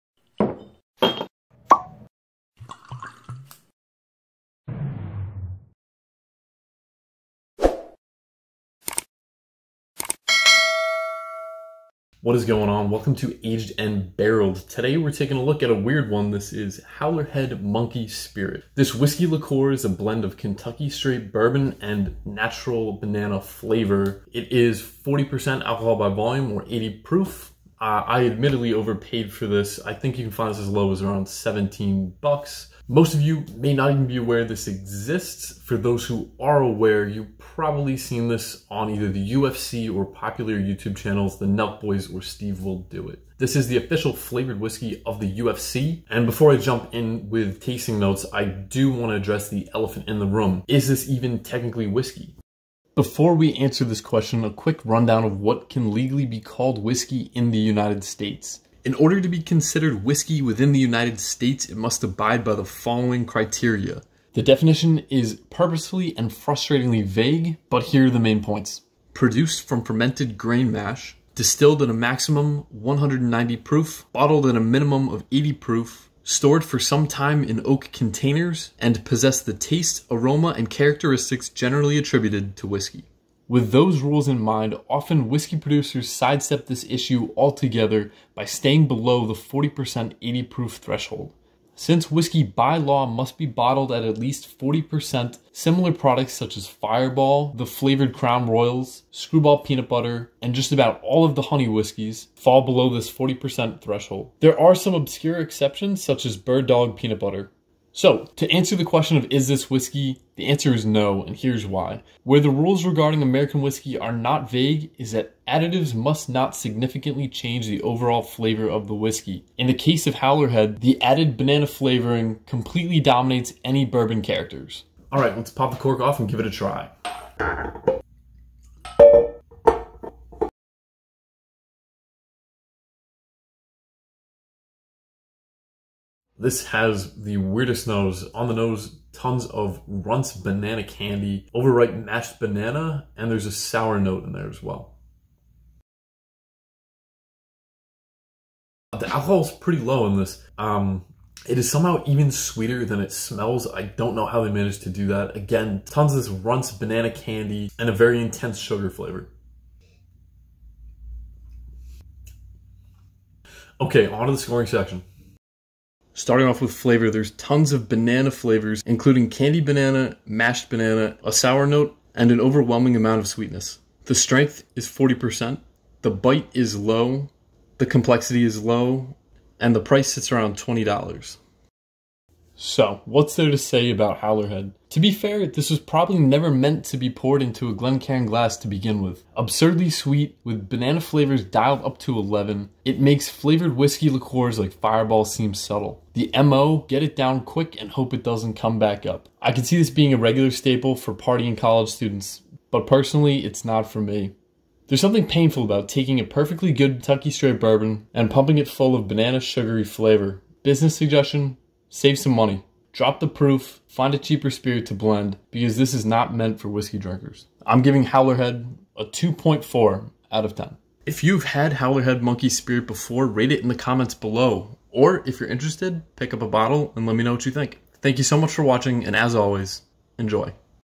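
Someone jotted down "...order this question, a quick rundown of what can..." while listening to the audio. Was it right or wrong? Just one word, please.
wrong.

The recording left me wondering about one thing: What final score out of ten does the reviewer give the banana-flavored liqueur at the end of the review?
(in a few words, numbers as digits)
2.4.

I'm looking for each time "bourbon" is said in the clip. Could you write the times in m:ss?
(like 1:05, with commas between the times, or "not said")
0:21, 2:03, 3:27.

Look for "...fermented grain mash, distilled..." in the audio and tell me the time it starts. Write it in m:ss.
1:09.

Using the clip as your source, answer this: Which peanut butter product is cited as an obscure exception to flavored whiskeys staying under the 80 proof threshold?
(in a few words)
Bird Dog Peanut Butter.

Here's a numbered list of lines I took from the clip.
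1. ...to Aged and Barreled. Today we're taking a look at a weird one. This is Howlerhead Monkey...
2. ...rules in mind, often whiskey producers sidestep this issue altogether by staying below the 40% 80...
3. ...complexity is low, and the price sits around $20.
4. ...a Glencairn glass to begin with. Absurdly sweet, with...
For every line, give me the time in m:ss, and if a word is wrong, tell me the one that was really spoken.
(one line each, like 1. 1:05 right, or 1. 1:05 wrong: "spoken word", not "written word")
1. 0:13 right
2. 1:23 right
3. 2:57 right
4. 3:07 right.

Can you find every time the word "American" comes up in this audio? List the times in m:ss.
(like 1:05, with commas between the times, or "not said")
1:53.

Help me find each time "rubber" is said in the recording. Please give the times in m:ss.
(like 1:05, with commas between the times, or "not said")
not said.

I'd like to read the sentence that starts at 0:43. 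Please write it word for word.
This is the official flavored whiskey of the UFC.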